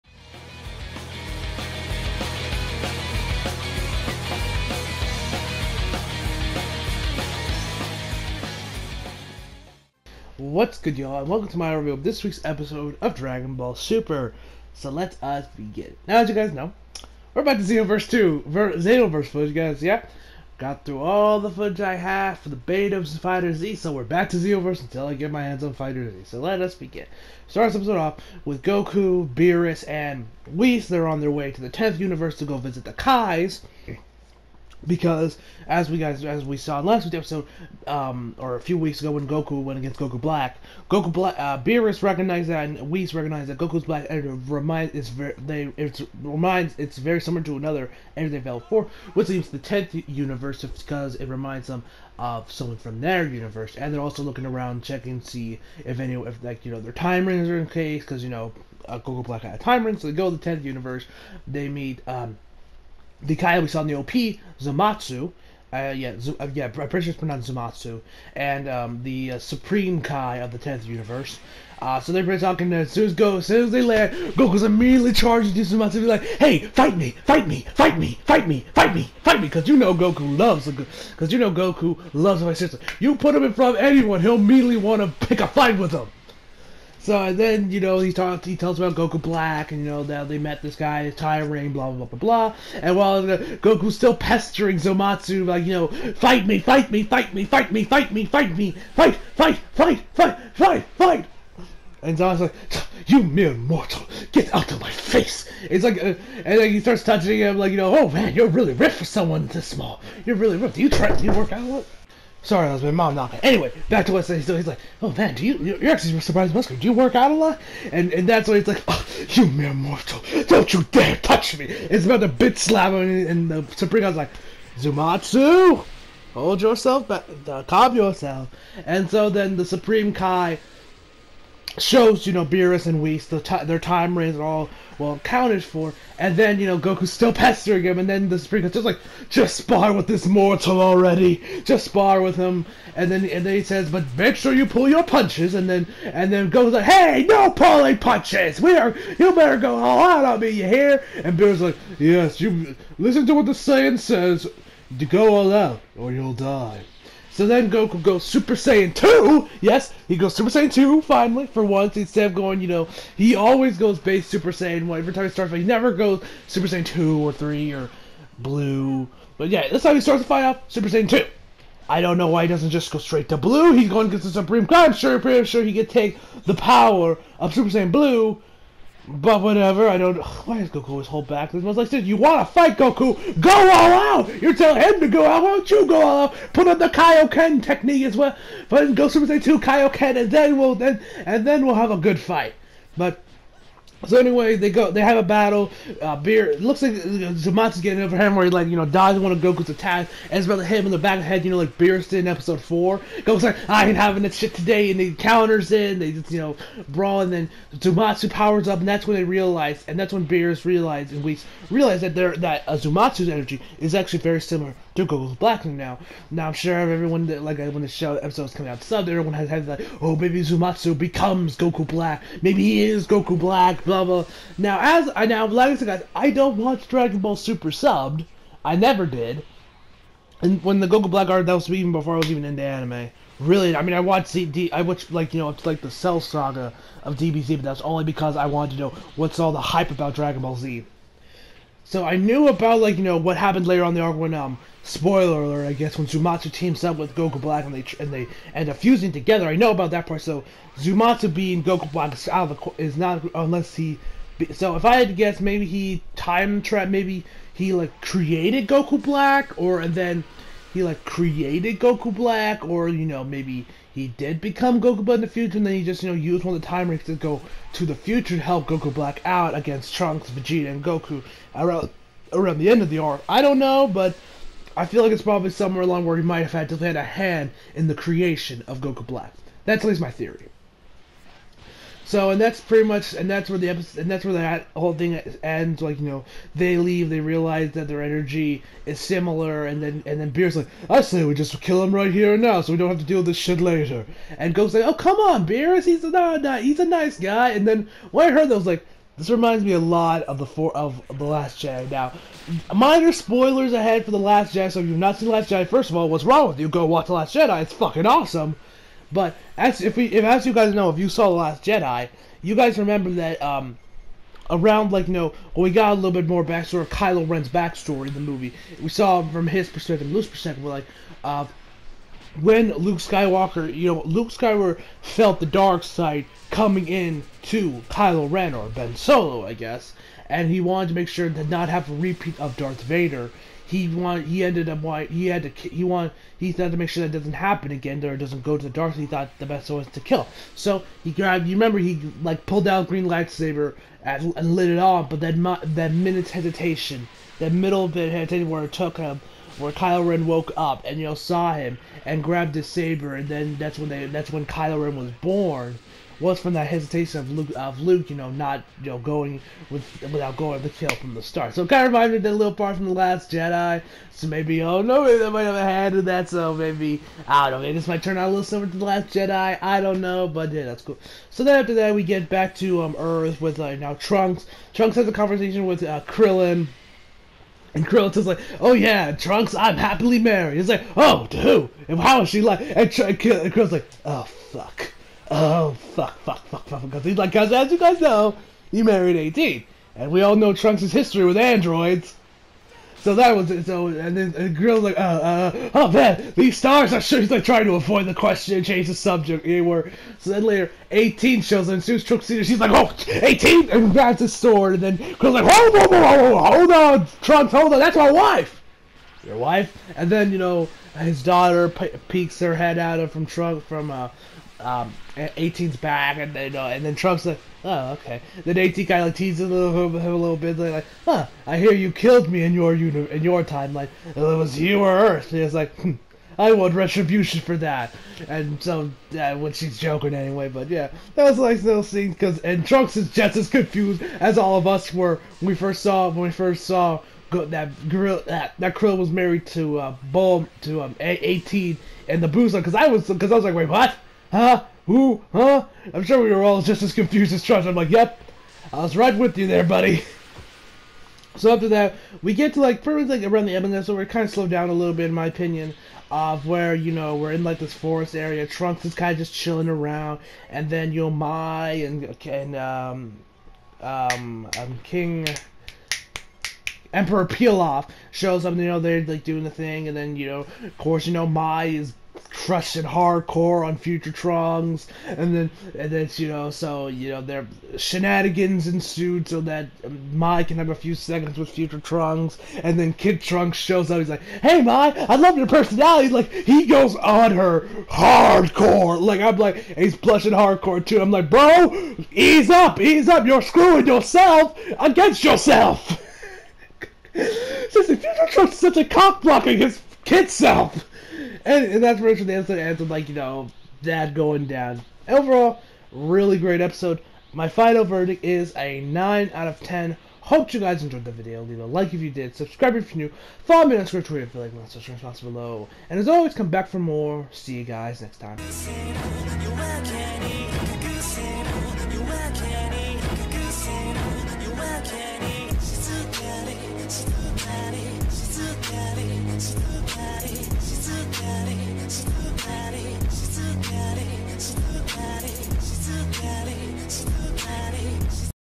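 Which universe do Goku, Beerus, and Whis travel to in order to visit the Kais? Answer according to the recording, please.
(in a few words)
10th universe.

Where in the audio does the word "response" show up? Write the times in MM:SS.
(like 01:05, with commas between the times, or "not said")
08:34.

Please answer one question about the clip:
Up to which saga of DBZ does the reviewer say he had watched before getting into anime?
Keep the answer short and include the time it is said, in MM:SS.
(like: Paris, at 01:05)
Cell Saga, at 03:55.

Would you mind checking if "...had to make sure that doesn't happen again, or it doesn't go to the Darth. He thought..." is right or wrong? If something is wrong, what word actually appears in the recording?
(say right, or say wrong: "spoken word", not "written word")
right.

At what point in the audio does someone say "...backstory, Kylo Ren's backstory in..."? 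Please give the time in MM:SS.
05:16.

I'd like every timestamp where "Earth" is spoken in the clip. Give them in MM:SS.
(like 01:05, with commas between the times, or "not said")
06:12, 07:04.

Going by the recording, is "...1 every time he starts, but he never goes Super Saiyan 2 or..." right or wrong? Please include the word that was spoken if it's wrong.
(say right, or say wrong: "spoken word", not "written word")
right.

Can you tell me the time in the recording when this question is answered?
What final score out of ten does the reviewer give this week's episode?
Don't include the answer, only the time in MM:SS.
08:28.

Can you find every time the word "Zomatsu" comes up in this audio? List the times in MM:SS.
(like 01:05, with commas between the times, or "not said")
01:34, 01:42.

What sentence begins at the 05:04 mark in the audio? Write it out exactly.
So if you've not seen Last Jedi, first of all, what's wrong with you?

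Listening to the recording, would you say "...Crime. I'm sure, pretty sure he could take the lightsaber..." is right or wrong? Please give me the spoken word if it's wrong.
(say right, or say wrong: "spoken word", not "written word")
wrong: "power", not "lightsaber".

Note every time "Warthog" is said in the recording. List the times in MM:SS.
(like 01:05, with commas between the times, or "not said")
not said.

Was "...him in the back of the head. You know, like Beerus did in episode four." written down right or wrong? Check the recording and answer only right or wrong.
right.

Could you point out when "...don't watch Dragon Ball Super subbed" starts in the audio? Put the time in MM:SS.
03:46.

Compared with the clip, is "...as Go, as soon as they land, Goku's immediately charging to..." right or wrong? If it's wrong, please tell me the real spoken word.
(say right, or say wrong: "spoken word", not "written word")
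right.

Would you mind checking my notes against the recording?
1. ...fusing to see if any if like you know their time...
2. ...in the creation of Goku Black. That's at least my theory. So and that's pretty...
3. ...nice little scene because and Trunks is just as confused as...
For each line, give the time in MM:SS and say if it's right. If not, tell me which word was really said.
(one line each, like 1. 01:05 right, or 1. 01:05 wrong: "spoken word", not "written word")
1. 00:54 wrong: "checking", not "fusing"
2. 04:37 right
3. 07:11 right.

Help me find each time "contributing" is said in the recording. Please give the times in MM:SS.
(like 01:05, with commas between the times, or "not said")
not said.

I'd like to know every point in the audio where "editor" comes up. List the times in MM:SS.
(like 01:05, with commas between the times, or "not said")
00:44, 00:48.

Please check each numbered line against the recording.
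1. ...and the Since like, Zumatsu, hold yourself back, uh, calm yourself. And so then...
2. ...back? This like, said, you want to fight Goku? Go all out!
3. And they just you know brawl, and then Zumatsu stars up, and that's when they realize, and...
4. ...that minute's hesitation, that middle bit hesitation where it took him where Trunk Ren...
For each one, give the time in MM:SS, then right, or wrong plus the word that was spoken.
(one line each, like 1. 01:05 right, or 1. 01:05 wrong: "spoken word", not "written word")
1. 02:03 wrong: "Supreme", not "Since"
2. 03:01 right
3. 03:25 wrong: "powers", not "stars"
4. 05:45 wrong: "Kylo", not "Trunk".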